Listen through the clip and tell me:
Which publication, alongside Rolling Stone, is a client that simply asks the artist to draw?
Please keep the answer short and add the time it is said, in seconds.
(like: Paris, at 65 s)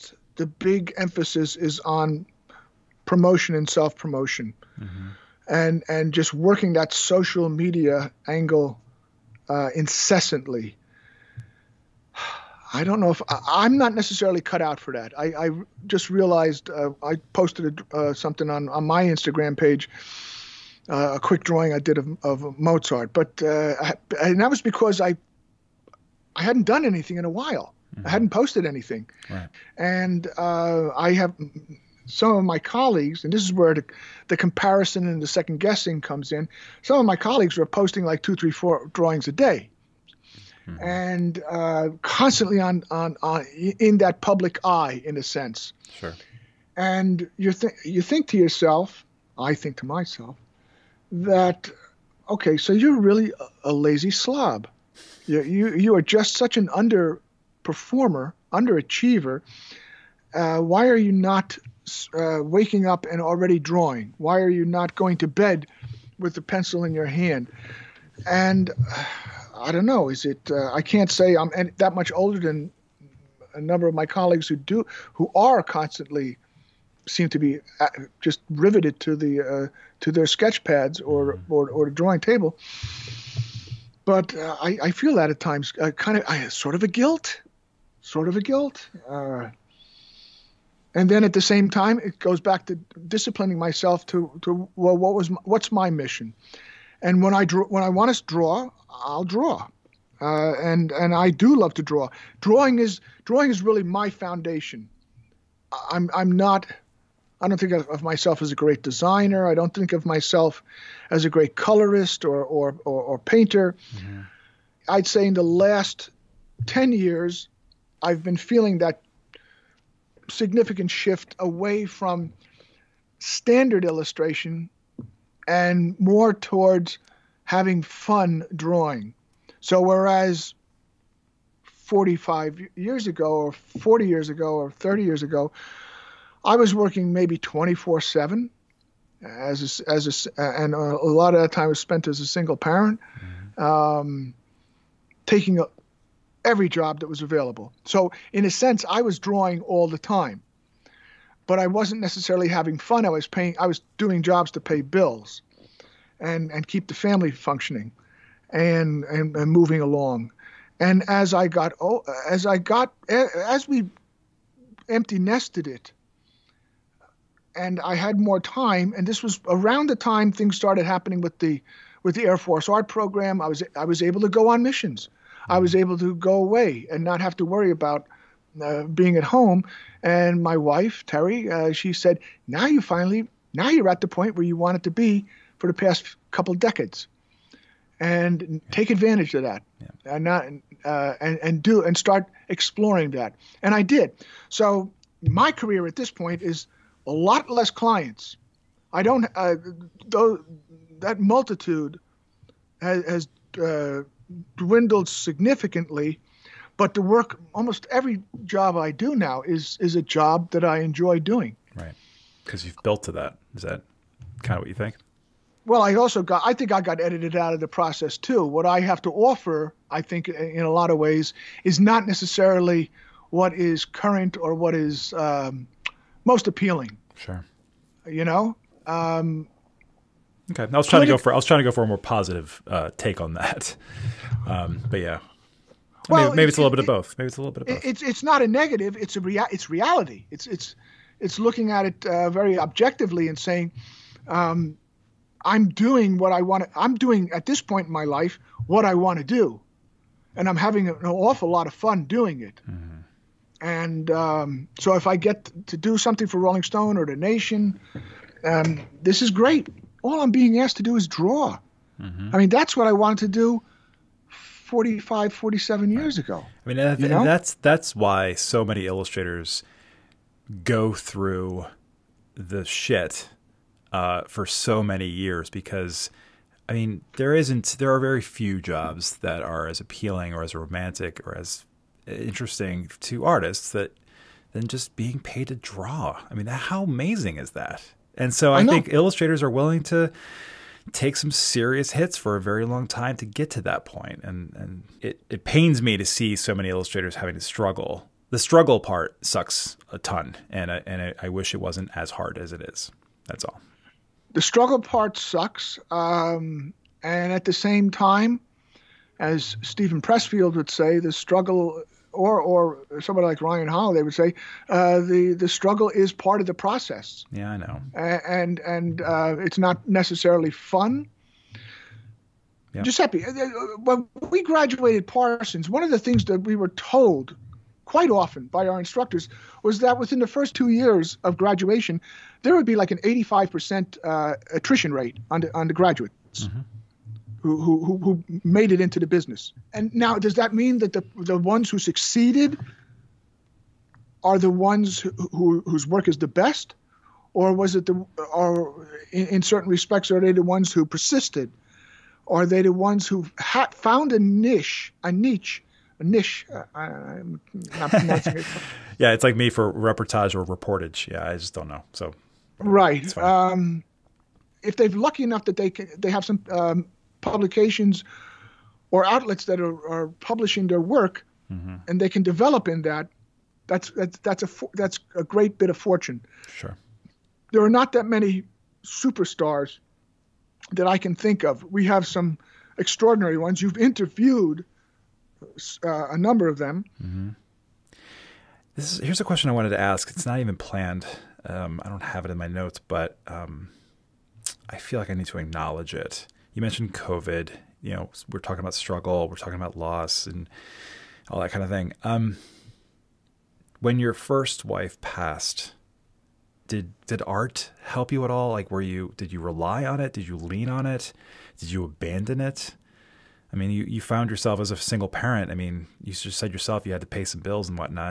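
The Nation, at 257 s.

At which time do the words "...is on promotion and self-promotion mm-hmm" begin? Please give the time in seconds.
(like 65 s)
1 s.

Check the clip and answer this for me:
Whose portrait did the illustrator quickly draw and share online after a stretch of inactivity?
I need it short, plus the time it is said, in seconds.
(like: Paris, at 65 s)
Mozart, at 22 s.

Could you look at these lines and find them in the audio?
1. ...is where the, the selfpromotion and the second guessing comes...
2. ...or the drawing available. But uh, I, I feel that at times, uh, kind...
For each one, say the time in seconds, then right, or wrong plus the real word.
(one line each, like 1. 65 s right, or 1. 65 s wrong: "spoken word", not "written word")
1. 33 s wrong: "comparison", not "selfpromotion"
2. 81 s wrong: "table", not "available".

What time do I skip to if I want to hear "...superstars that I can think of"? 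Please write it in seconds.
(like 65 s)
378 s.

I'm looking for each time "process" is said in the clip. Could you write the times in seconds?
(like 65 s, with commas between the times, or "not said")
217 s, 316 s.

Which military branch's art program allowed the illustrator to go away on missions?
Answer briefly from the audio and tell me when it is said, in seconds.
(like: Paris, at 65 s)
Air Force, at 172 s.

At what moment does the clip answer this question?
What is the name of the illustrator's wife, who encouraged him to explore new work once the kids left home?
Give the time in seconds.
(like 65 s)
181 s.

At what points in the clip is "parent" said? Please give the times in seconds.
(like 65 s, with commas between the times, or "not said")
142 s, 415 s.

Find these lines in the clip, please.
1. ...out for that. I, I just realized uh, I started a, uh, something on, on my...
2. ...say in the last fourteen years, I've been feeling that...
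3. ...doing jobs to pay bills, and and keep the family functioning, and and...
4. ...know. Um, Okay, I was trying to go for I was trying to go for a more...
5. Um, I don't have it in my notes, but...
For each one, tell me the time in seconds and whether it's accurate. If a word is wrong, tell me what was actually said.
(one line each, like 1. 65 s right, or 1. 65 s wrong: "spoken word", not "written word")
1. 14 s wrong: "posted", not "started"
2. 115 s wrong: "ten", not "fourteen"
3. 153 s right
4. 228 s right
5. 391 s right.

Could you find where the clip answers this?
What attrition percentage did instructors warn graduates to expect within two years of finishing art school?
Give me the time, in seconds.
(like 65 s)
332 s.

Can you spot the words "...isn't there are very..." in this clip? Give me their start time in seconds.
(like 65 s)
277 s.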